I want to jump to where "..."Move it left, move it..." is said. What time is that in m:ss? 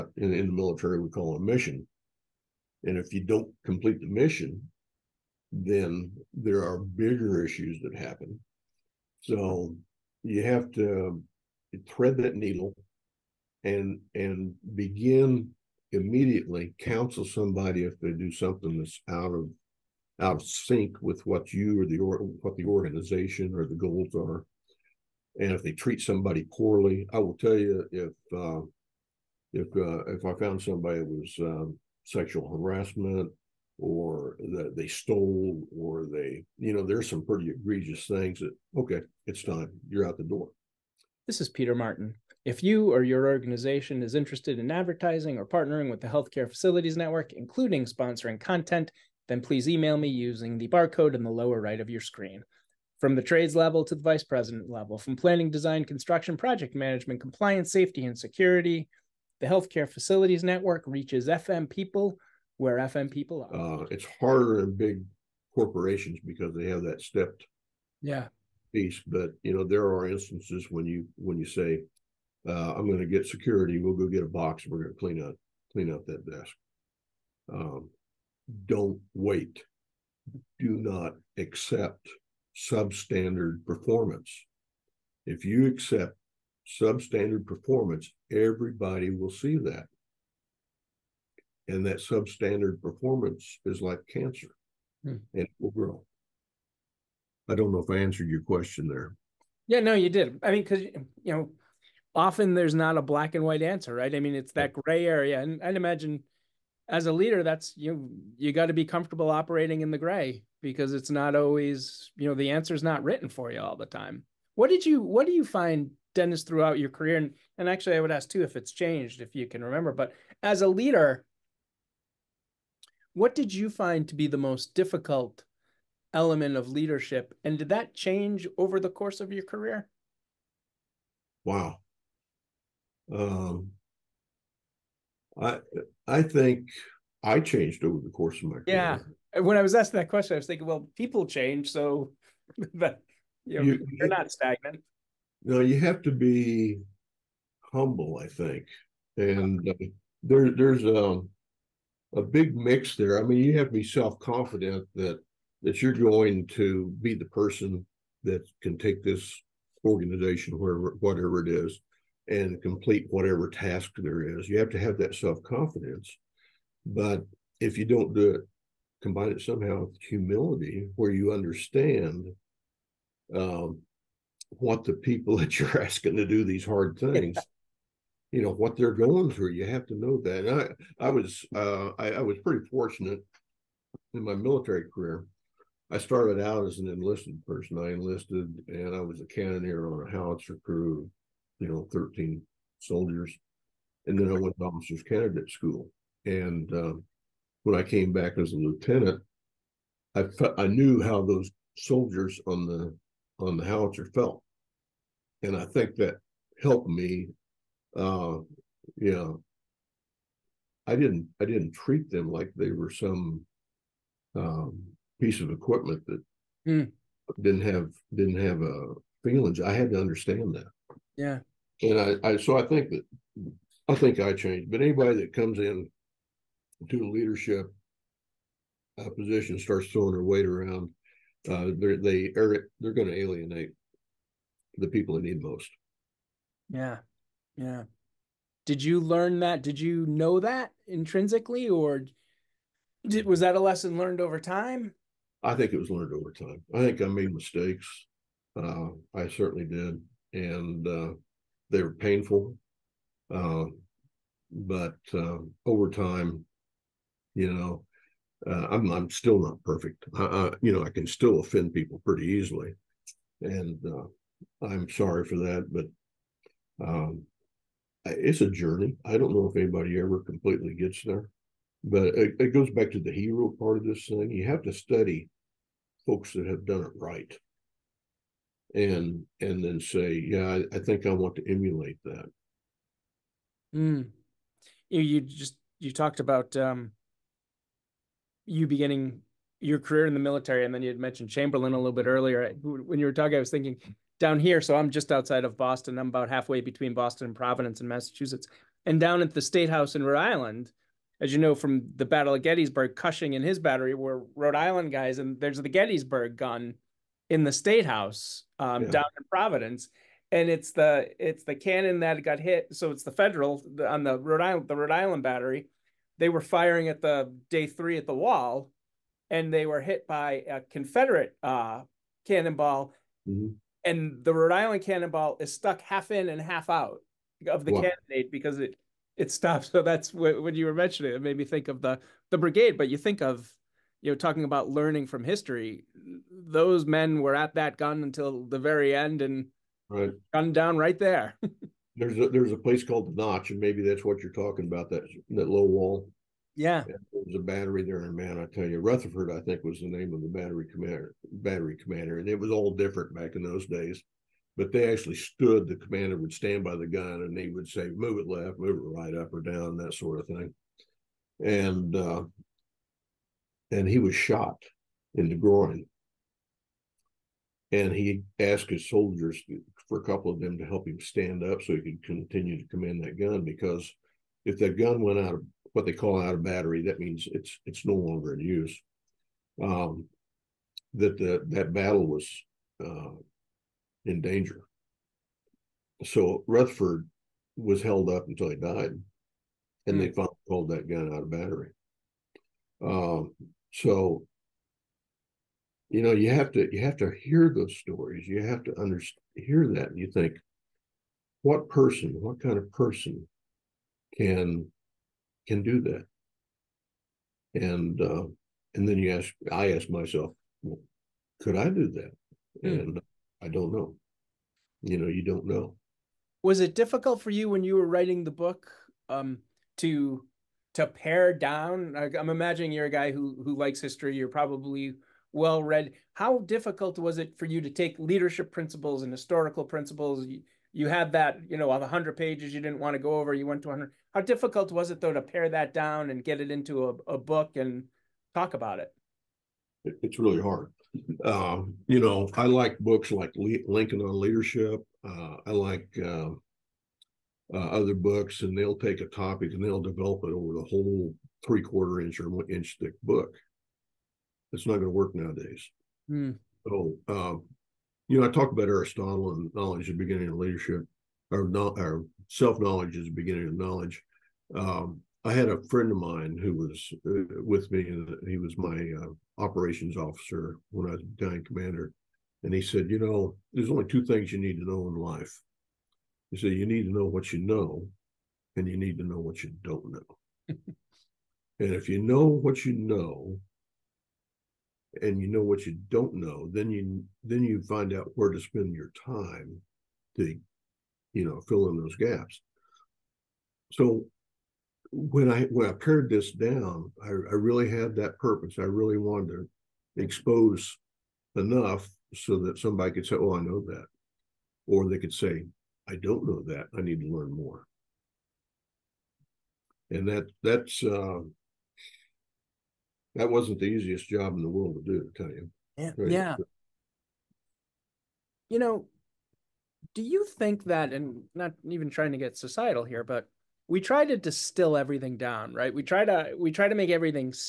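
5:57.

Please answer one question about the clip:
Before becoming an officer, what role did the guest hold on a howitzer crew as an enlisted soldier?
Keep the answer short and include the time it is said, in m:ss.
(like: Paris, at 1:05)
cannoneer, at 3:09.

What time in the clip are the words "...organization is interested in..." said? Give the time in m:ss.
0:43.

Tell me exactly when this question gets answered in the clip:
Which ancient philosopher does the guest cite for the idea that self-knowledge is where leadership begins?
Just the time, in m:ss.
7:38.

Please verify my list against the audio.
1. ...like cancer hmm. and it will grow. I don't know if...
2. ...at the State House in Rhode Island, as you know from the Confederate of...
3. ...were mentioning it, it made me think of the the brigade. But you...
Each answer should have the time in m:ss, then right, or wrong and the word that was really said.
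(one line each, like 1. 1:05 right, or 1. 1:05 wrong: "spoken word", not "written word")
1. 1:33 right
2. 4:59 wrong: "Battle", not "Confederate"
3. 5:30 right.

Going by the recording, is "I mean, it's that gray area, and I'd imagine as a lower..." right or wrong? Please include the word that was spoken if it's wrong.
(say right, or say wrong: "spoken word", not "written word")
wrong: "leader", not "lower".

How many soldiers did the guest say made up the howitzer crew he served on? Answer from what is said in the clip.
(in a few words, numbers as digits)
13.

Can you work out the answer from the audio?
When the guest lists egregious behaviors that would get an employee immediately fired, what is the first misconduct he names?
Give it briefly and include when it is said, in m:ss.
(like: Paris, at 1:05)
sexual harassment, at 0:32.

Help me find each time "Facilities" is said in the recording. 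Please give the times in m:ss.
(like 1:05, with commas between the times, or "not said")
0:46, 0:59.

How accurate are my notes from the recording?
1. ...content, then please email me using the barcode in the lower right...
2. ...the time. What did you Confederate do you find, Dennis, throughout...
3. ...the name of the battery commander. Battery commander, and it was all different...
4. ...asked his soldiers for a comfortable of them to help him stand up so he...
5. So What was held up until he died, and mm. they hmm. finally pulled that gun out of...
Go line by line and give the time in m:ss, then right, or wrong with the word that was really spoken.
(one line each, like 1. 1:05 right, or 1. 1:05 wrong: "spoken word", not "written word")
1. 0:48 right
2. 1:53 wrong: "What", not "Confederate"
3. 5:49 right
4. 6:08 wrong: "couple", not "comfortable"
5. 6:26 wrong: "Rutherford", not "What".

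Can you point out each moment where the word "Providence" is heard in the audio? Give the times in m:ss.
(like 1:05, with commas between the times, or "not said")
4:57, 5:09.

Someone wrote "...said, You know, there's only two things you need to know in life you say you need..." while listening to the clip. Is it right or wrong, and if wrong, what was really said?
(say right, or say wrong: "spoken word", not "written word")
right.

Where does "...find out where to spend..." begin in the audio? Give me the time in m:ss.
8:07.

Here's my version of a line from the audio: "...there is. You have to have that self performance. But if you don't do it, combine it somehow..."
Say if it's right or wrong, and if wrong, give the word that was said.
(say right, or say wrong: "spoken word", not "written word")
wrong: "confidence", not "performance".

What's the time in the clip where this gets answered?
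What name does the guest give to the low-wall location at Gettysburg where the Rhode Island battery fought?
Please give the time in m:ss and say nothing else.
5:43.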